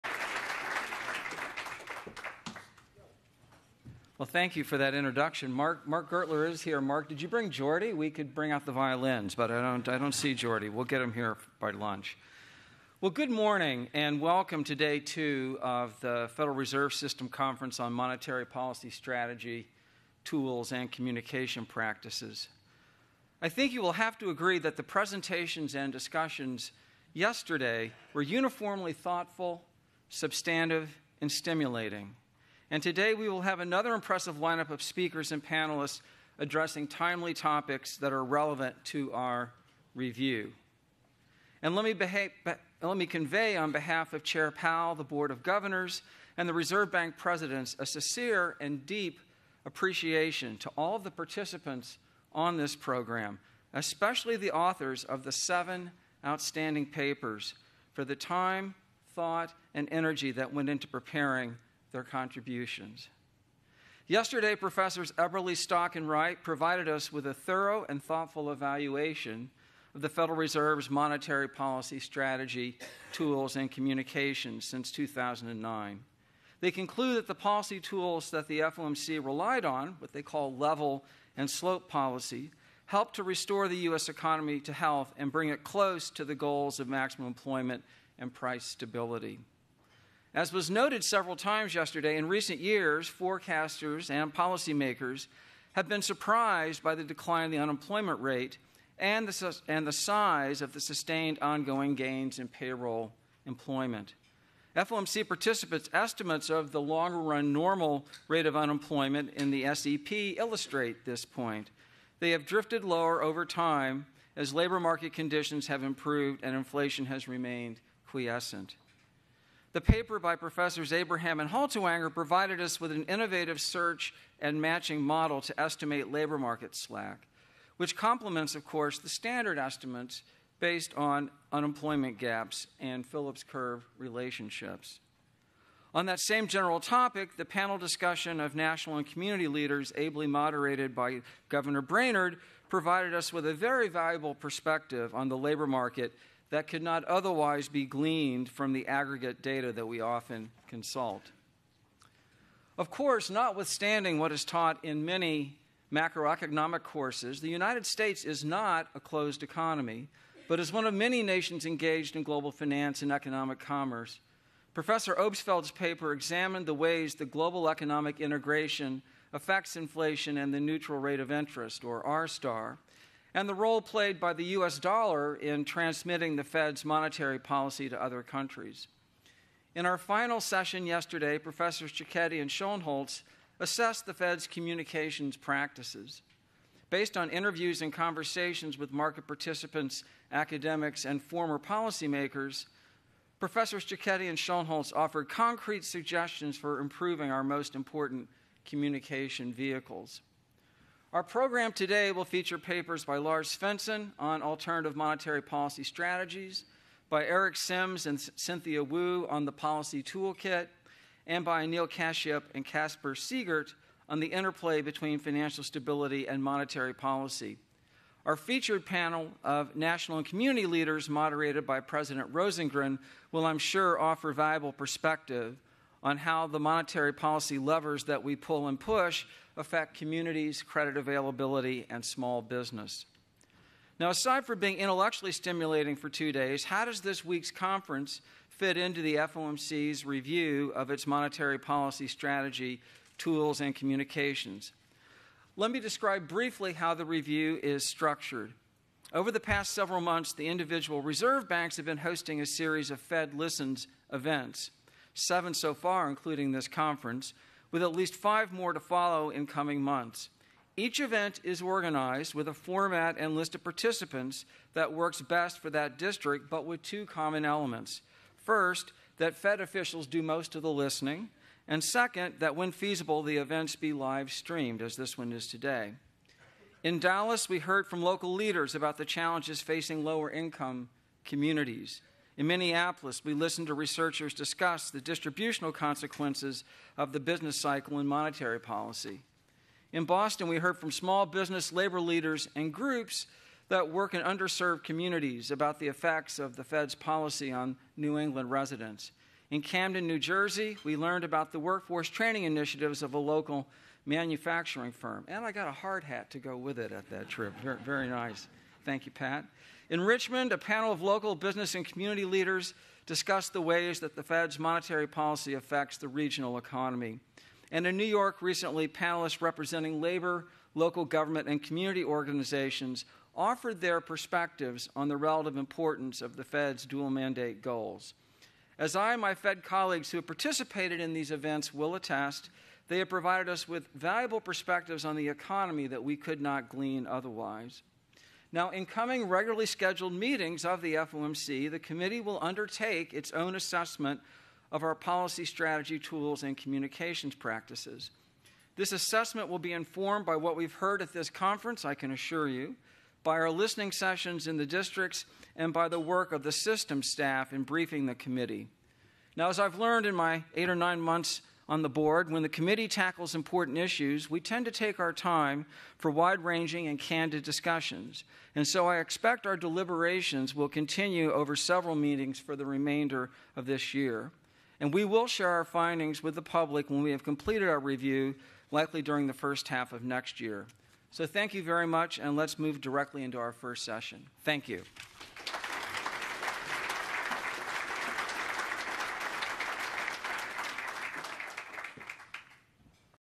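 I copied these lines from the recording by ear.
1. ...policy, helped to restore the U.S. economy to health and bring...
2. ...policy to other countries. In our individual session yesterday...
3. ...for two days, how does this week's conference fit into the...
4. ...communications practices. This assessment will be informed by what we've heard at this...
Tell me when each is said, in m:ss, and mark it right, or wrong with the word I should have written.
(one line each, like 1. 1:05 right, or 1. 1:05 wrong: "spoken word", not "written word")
1. 1:21 right
2. 2:57 wrong: "final", not "individual"
3. 3:55 right
4. 5:46 right.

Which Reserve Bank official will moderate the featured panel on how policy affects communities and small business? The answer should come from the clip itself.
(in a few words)
President Rosengren.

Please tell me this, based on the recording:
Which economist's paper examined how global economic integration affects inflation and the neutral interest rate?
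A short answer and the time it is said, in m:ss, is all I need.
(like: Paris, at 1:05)
Obstfeld, at 2:45.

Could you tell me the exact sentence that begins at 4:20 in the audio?
Each event is organized with a format and list of participants that works best for that district, but with two common elements.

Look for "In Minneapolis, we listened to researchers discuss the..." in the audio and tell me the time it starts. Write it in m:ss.
4:42.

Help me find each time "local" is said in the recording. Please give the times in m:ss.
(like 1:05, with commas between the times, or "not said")
4:38, 5:03, 5:11, 5:20.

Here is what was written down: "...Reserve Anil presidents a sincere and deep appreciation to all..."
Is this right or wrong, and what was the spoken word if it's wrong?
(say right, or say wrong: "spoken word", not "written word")
wrong: "Bank", not "Anil".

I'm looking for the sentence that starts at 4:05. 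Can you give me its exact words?
Let me describe briefly how the review is structured.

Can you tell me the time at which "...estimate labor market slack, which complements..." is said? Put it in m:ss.
2:05.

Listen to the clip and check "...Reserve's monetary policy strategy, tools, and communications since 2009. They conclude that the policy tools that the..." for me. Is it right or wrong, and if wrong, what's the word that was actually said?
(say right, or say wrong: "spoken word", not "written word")
right.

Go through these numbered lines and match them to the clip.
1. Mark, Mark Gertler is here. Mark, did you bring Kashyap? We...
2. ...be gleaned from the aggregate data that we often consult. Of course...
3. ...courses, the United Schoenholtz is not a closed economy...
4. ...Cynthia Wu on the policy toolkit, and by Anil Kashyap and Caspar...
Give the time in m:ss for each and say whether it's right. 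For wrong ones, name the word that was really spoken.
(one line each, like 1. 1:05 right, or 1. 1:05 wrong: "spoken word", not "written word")
1. 0:05 wrong: "Jordi", not "Kashyap"
2. 2:27 right
3. 2:36 wrong: "States", not "Schoenholtz"
4. 3:28 right.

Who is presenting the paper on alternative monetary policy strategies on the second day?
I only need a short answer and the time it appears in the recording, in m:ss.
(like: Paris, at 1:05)
Lars Svensson, at 3:23.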